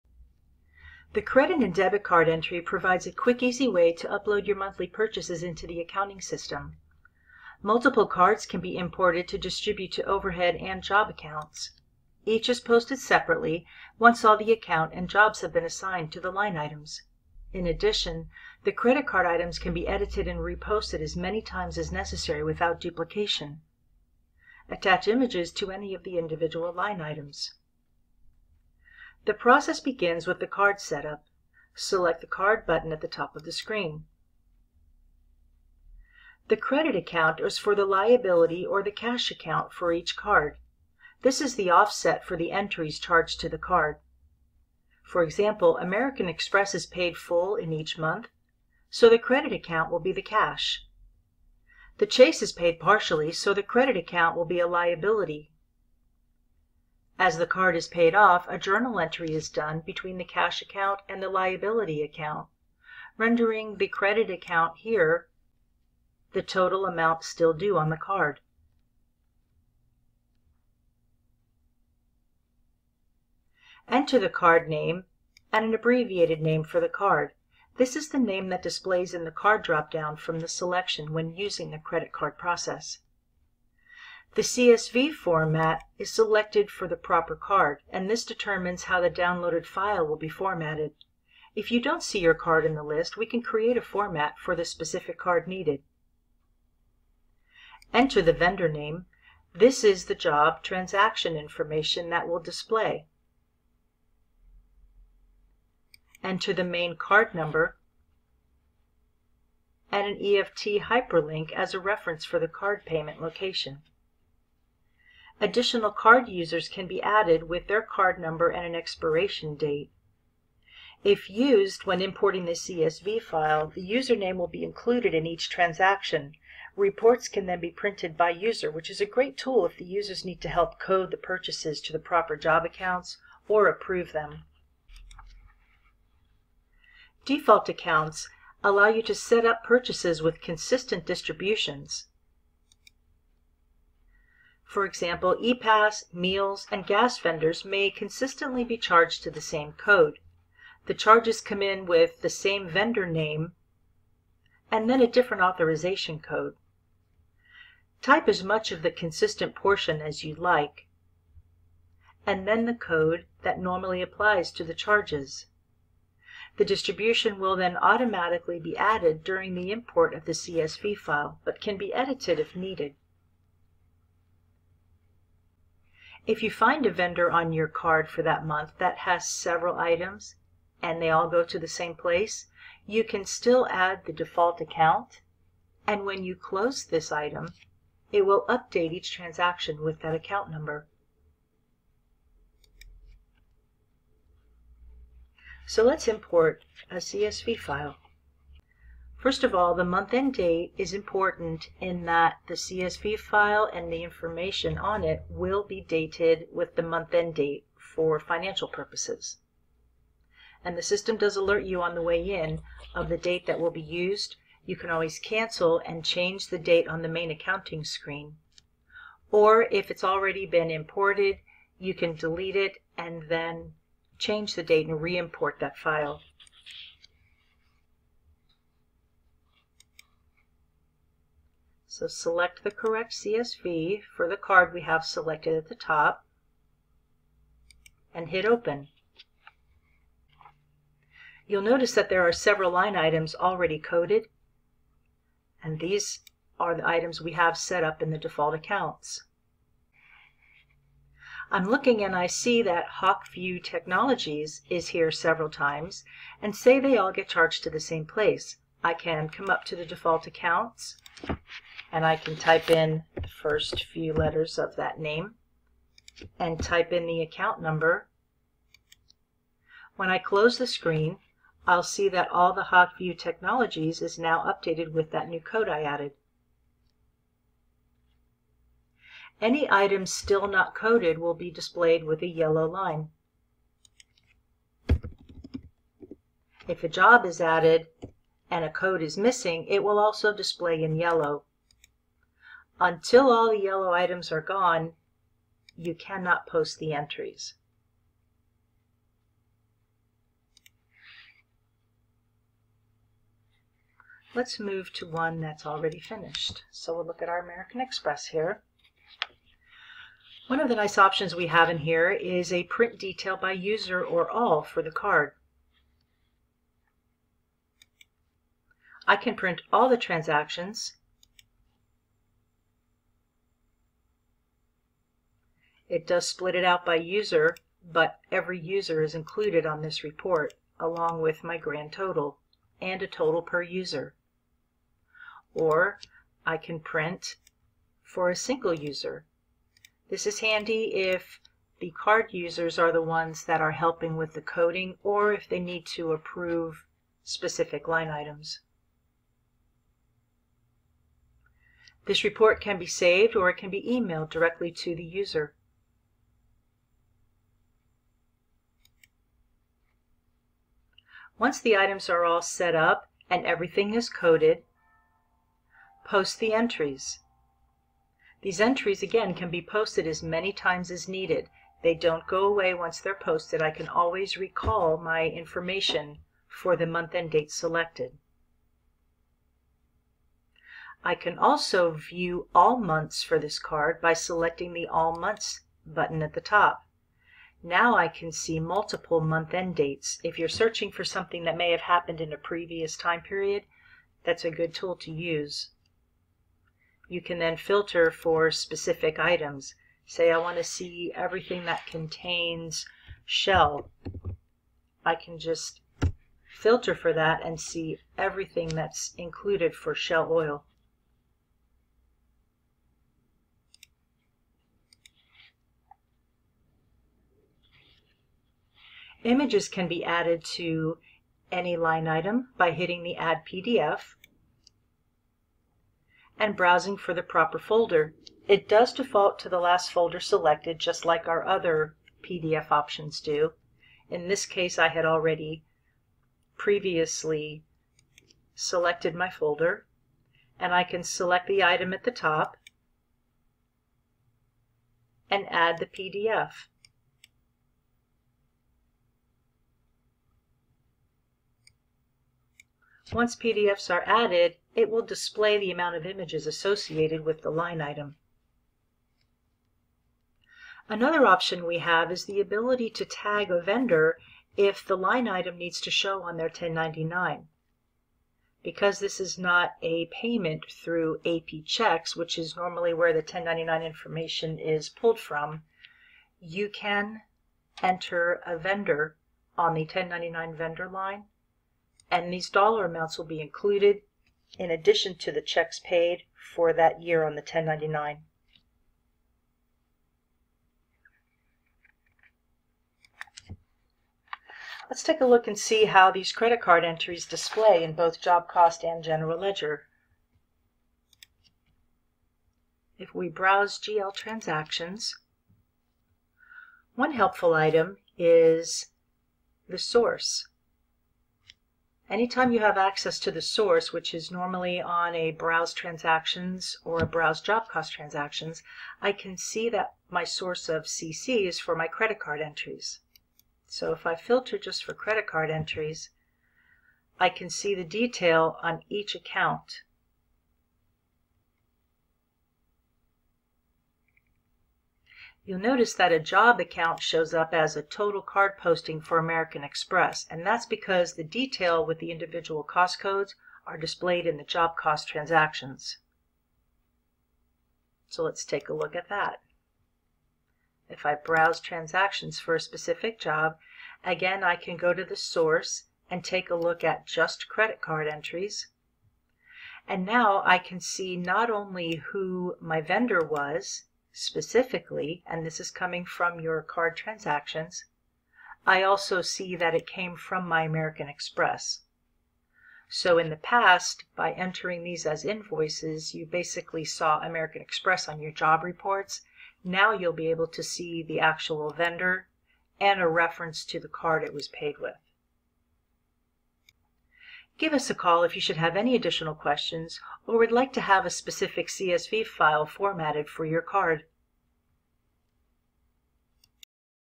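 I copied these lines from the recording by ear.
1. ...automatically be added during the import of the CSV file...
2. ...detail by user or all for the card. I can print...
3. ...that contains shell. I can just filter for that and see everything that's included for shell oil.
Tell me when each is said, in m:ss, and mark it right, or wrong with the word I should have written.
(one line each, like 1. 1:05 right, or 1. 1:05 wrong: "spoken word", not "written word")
1. 2:47 right
2. 5:12 right
3. 6:41 right.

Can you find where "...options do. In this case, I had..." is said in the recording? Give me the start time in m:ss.
7:12.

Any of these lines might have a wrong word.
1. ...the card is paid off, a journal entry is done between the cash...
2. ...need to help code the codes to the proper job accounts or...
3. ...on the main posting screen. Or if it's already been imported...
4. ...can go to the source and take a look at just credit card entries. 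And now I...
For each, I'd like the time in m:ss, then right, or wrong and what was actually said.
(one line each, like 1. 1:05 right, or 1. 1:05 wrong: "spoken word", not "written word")
1. 0:57 right
2. 2:10 wrong: "purchases", not "codes"
3. 3:36 wrong: "accounting", not "posting"
4. 9:14 right.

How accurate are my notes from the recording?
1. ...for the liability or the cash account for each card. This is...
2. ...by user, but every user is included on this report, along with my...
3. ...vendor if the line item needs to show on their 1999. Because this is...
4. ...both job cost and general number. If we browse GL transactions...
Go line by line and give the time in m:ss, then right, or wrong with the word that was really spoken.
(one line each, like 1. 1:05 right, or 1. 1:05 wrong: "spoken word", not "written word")
1. 0:37 right
2. 5:26 right
3. 7:43 wrong: "1099", not "1999"
4. 8:17 wrong: "ledger", not "number".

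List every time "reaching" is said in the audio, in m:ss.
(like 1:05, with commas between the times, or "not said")
not said.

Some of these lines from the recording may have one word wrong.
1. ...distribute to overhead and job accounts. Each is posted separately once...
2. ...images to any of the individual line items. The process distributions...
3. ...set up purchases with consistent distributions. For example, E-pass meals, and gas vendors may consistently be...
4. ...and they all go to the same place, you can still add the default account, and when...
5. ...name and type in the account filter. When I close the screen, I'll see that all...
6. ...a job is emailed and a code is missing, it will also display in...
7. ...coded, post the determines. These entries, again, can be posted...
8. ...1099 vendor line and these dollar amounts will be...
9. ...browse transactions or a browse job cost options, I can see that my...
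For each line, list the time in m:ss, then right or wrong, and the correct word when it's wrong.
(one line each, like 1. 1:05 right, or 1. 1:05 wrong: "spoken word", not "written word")
1. 0:09 right
2. 0:25 wrong: "begins", not "distributions"
3. 2:19 right
4. 3:00 right
5. 4:24 wrong: "number", not "filter"
6. 4:46 wrong: "added", not "emailed"
7. 6:04 wrong: "entries", not "determines"
8. 7:59 right
9. 8:35 wrong: "transactions", not "options".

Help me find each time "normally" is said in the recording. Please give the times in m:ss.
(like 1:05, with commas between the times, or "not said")
2:43, 7:52, 8:34.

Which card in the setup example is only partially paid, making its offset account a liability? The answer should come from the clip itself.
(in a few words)
Chase.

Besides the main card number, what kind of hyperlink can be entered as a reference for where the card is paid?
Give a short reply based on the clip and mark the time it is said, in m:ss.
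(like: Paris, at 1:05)
EFT hyperlink, at 1:50.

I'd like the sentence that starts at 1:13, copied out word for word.
Enter the card name and an abbreviated name for the card.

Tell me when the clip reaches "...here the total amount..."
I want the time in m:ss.
1:04.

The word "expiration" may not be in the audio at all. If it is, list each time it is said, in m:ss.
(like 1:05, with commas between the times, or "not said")
1:58.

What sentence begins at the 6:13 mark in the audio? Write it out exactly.
I can always recall my information for the month and date selected.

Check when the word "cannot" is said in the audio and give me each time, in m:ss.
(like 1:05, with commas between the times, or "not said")
4:55.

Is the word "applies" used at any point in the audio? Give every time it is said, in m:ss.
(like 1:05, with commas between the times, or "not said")
2:44.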